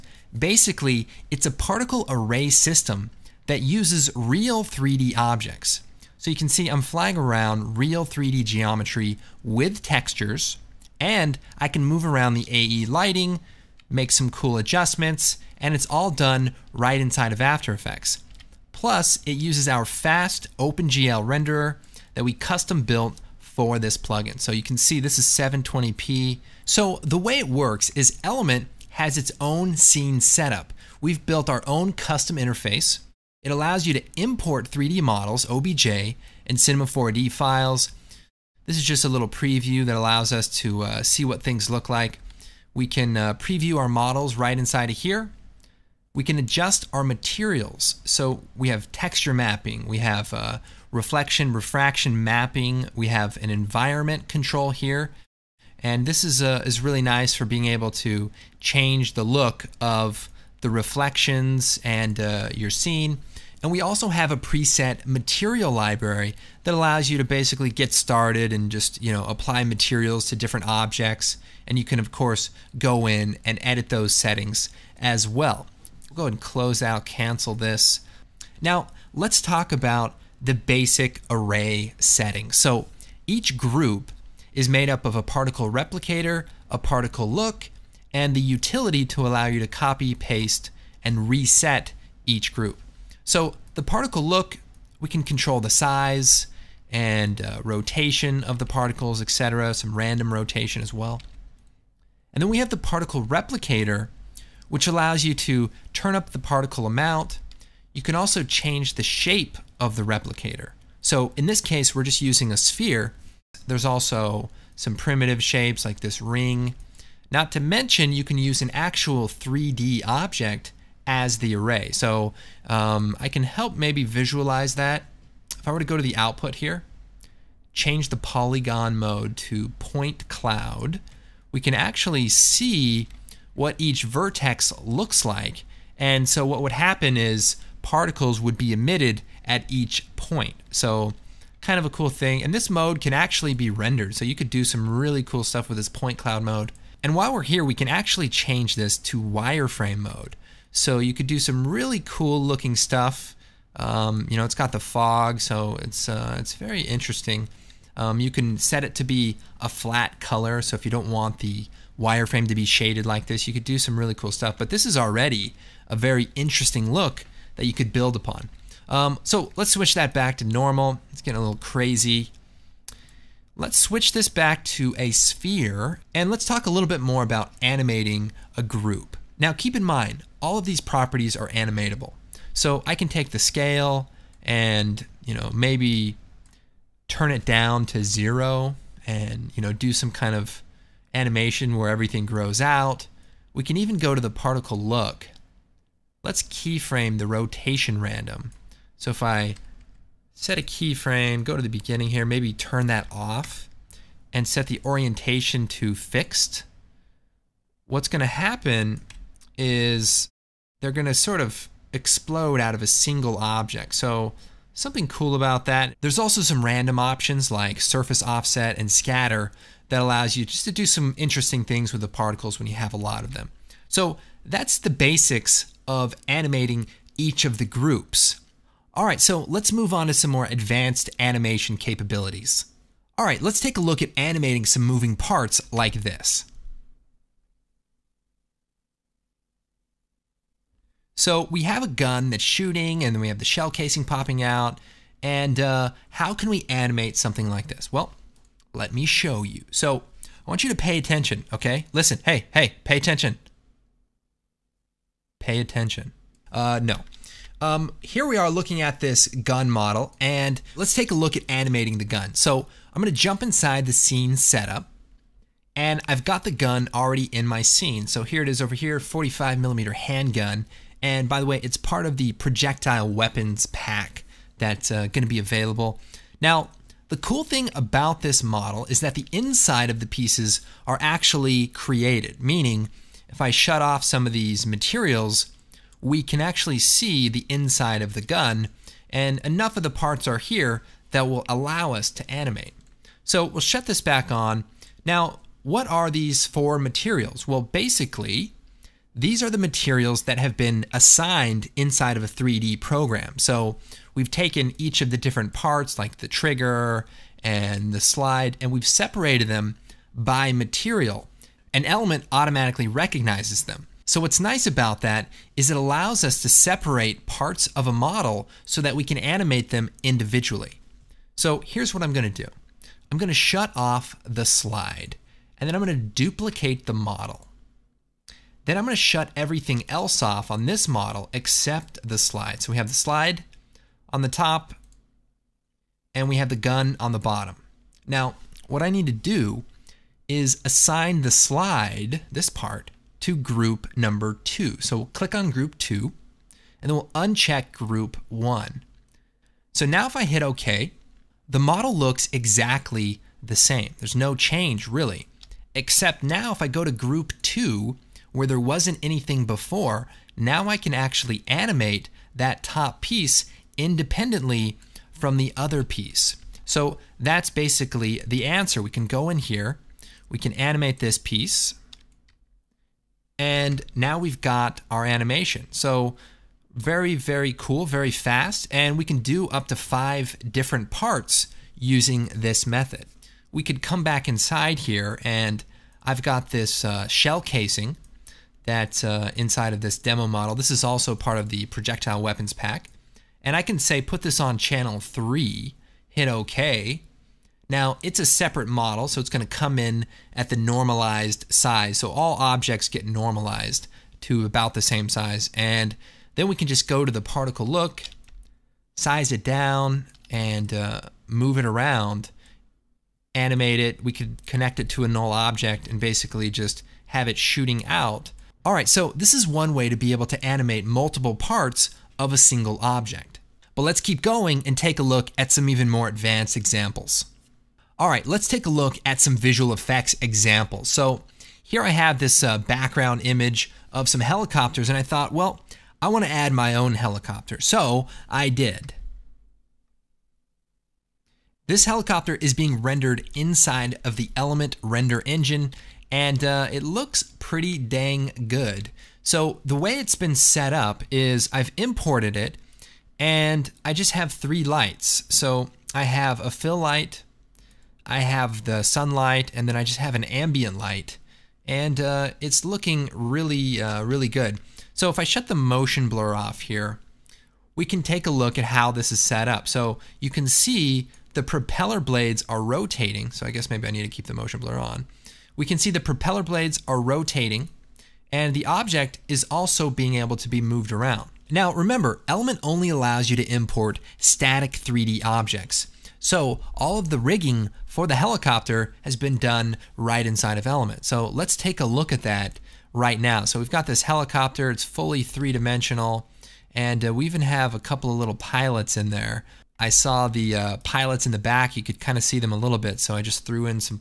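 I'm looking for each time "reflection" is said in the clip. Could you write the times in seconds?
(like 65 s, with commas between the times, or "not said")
50 s, 60 s.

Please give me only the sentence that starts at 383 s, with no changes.
We could come back inside here and I've got this uh, shell casing that's uh, inside of this demo model.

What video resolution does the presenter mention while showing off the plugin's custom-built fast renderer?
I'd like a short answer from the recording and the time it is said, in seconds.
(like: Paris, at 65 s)
720p, at 25 s.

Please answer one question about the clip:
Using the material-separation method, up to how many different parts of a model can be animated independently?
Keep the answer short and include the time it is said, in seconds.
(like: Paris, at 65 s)
5, at 379 s.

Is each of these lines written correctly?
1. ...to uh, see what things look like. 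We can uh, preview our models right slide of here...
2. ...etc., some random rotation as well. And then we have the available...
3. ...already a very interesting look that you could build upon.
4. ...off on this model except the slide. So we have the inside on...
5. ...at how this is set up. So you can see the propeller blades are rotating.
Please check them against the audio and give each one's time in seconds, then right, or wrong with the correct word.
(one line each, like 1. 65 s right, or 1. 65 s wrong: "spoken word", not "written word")
1. 40 s wrong: "inside", not "slide"
2. 99 s wrong: "particle", not "available"
3. 164 s right
4. 330 s wrong: "slide", not "inside"
5. 468 s right.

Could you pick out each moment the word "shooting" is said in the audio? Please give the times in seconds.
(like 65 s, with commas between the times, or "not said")
242 s, 417 s.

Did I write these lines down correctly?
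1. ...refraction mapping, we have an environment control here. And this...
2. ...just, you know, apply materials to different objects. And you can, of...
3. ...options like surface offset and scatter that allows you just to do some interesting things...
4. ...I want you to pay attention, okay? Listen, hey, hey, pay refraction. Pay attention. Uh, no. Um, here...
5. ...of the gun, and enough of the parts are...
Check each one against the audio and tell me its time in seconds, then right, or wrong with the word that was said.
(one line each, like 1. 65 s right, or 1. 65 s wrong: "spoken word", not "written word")
1. 51 s right
2. 68 s right
3. 216 s right
4. 250 s wrong: "attention", not "refraction"
5. 288 s right.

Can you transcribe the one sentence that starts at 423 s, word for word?
But let's keep going and take a look at some even more advanced examples.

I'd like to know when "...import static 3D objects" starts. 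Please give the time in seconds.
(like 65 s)
483 s.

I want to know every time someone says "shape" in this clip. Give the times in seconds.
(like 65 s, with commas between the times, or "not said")
109 s, 115 s.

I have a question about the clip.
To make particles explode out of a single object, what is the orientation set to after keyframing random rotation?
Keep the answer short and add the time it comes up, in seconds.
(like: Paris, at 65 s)
fixed, at 205 s.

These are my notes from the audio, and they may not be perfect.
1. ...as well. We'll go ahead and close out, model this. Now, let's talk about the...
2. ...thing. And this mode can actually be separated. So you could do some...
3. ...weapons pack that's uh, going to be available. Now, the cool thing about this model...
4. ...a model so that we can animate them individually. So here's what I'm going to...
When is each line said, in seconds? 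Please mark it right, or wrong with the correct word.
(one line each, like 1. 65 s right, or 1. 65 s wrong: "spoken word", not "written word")
1. 74 s wrong: "cancel", not "model"
2. 142 s wrong: "rendered", not "separated"
3. 273 s right
4. 317 s right.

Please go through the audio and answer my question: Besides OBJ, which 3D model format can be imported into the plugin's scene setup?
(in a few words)
Cinema 4D.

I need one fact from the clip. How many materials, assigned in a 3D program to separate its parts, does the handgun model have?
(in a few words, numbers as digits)
4.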